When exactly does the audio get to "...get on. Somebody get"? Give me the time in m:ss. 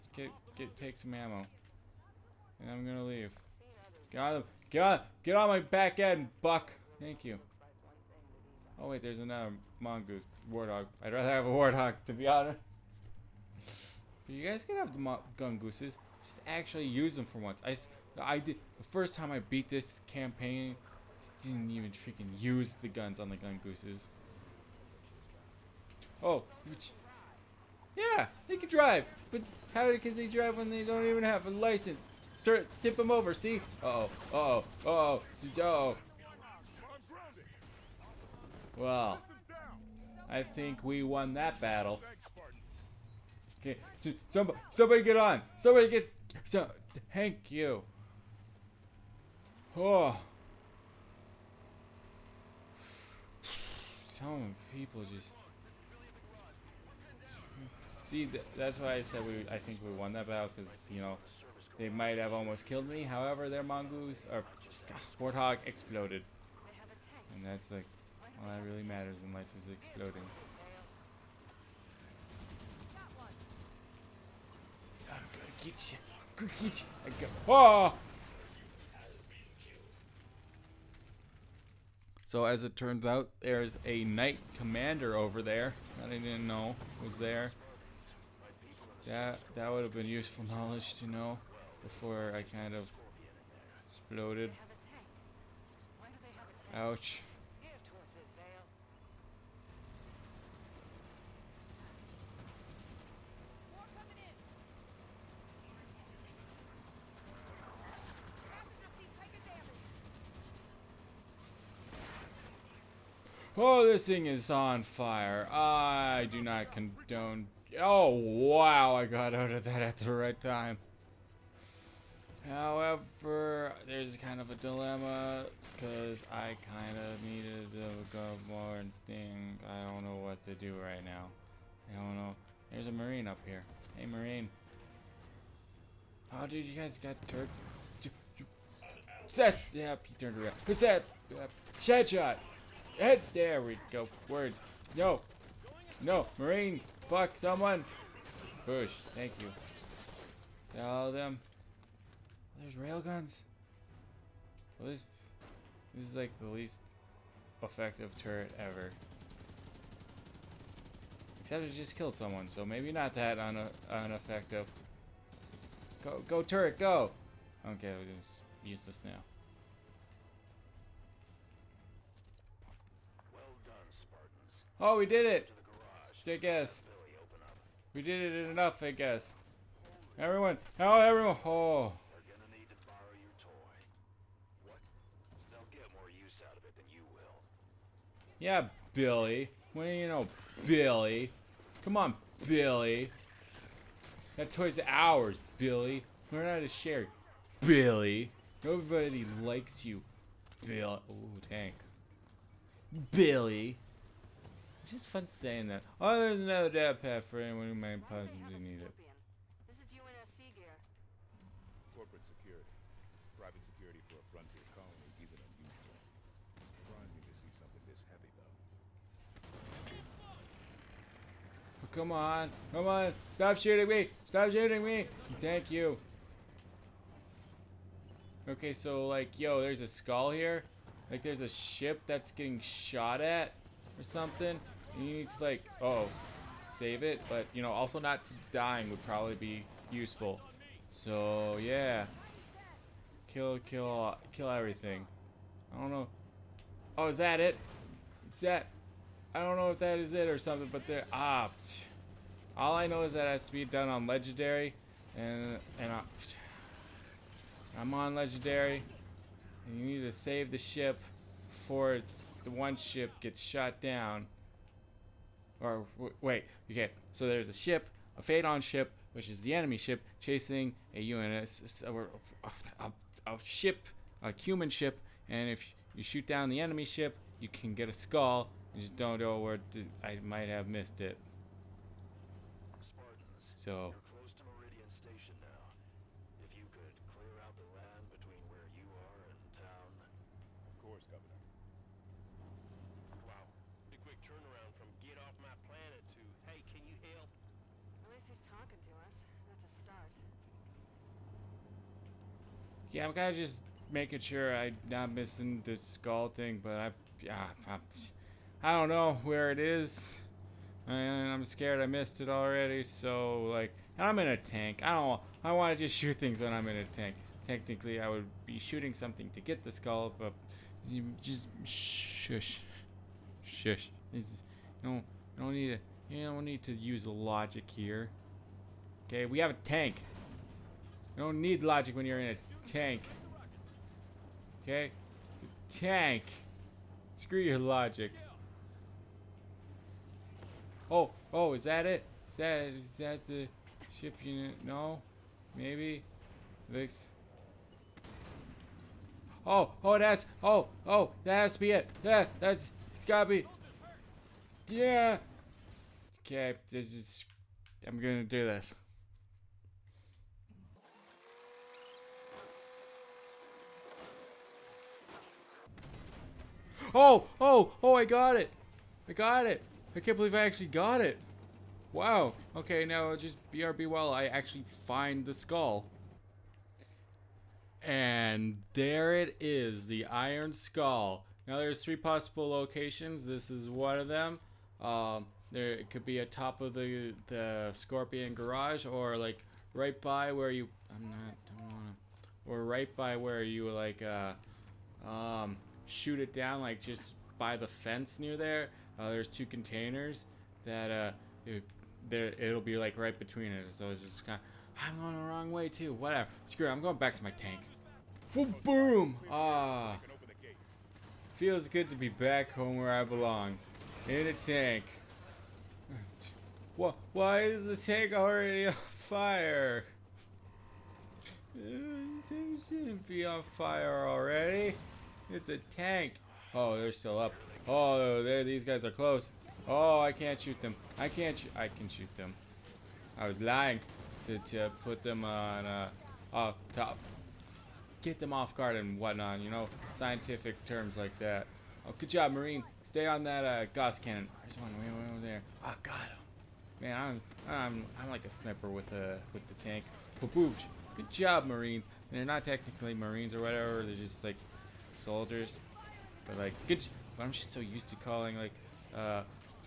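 0:45.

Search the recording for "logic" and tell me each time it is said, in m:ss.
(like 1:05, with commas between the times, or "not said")
5:27, 5:31, 5:37.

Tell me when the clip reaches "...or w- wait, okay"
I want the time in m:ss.
4:25.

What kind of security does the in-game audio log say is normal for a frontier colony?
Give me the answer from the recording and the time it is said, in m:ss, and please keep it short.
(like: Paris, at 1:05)
Private security, at 3:33.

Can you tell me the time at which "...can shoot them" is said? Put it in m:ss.
7:11.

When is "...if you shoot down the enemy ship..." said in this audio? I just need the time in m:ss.
4:35.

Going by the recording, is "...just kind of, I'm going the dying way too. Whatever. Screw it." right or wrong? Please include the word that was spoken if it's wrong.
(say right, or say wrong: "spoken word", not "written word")
wrong: "wrong", not "dying".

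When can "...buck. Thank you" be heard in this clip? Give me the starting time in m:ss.
0:06.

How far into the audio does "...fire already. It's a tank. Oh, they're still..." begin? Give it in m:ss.
7:03.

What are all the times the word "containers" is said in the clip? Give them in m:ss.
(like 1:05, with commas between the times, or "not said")
6:39.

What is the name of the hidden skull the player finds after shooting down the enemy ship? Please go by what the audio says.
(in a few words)
Iron Skull.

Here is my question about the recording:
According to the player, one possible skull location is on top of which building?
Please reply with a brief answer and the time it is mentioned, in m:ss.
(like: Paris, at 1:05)
Scorpion Garage, at 6:27.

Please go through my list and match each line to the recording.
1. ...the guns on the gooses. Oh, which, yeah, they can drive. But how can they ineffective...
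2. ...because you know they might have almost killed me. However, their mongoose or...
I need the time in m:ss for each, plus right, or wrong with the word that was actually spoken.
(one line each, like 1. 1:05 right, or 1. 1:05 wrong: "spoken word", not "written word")
1. 0:22 wrong: "drive", not "ineffective"
2. 1:00 right.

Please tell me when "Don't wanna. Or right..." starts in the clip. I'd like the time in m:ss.
6:31.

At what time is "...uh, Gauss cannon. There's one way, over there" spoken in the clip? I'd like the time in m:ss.
7:23.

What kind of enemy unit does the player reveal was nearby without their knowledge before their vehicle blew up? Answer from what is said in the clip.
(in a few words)
knight commander.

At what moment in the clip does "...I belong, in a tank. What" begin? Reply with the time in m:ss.
6:52.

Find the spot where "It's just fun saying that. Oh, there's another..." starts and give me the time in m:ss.
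3:24.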